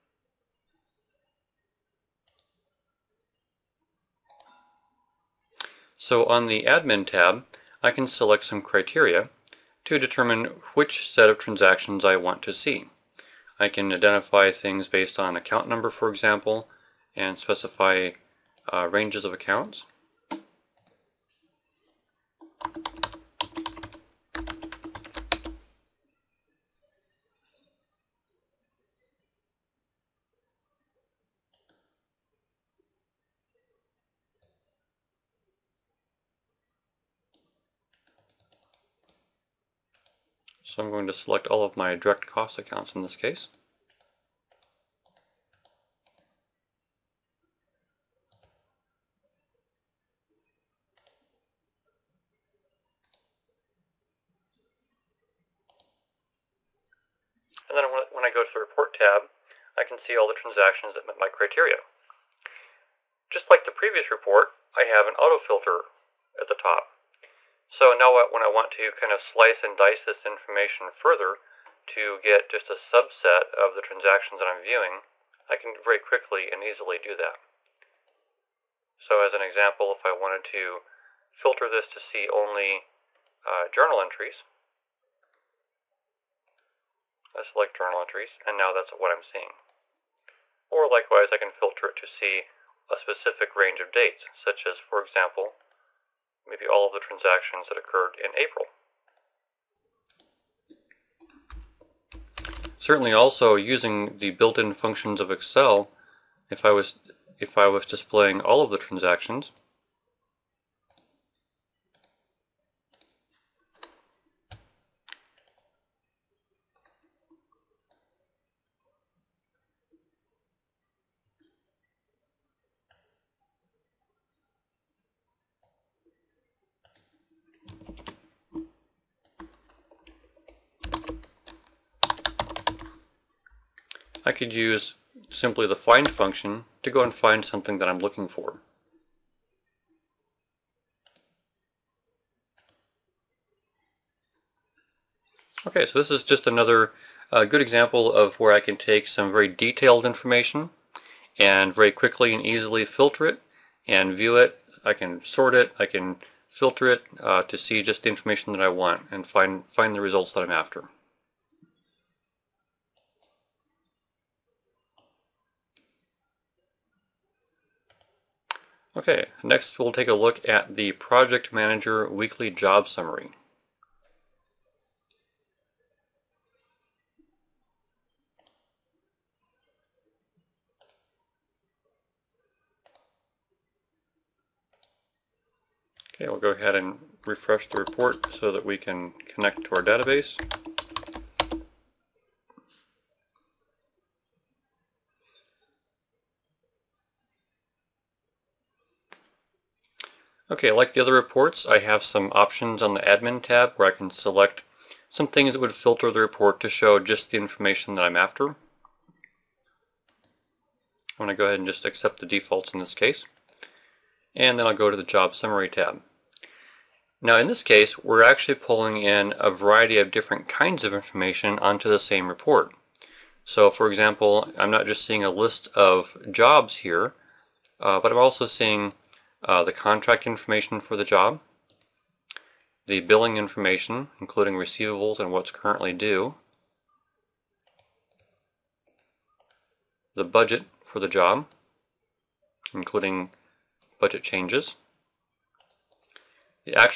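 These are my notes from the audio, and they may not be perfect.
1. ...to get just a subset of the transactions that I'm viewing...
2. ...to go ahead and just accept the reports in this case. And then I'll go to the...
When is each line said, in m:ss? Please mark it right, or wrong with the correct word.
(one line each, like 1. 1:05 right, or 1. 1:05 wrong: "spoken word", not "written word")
1. 1:11 right
2. 3:31 wrong: "defaults", not "reports".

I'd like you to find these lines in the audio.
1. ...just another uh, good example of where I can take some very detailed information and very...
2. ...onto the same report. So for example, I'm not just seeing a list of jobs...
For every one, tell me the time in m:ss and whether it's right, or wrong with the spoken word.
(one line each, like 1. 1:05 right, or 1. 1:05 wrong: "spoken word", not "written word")
1. 2:26 right
2. 3:41 right.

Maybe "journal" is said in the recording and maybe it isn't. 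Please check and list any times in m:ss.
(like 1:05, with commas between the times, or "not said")
1:23, 1:27.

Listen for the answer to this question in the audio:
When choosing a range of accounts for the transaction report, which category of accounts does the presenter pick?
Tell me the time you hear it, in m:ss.
0:41.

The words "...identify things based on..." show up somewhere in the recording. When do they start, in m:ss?
0:13.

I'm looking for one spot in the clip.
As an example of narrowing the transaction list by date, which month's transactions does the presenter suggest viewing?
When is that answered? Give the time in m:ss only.
1:38.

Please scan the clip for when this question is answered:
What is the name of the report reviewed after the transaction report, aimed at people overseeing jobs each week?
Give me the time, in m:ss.
2:50.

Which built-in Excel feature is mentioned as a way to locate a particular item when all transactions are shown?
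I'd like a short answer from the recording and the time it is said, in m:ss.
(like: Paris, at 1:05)
find function, at 2:15.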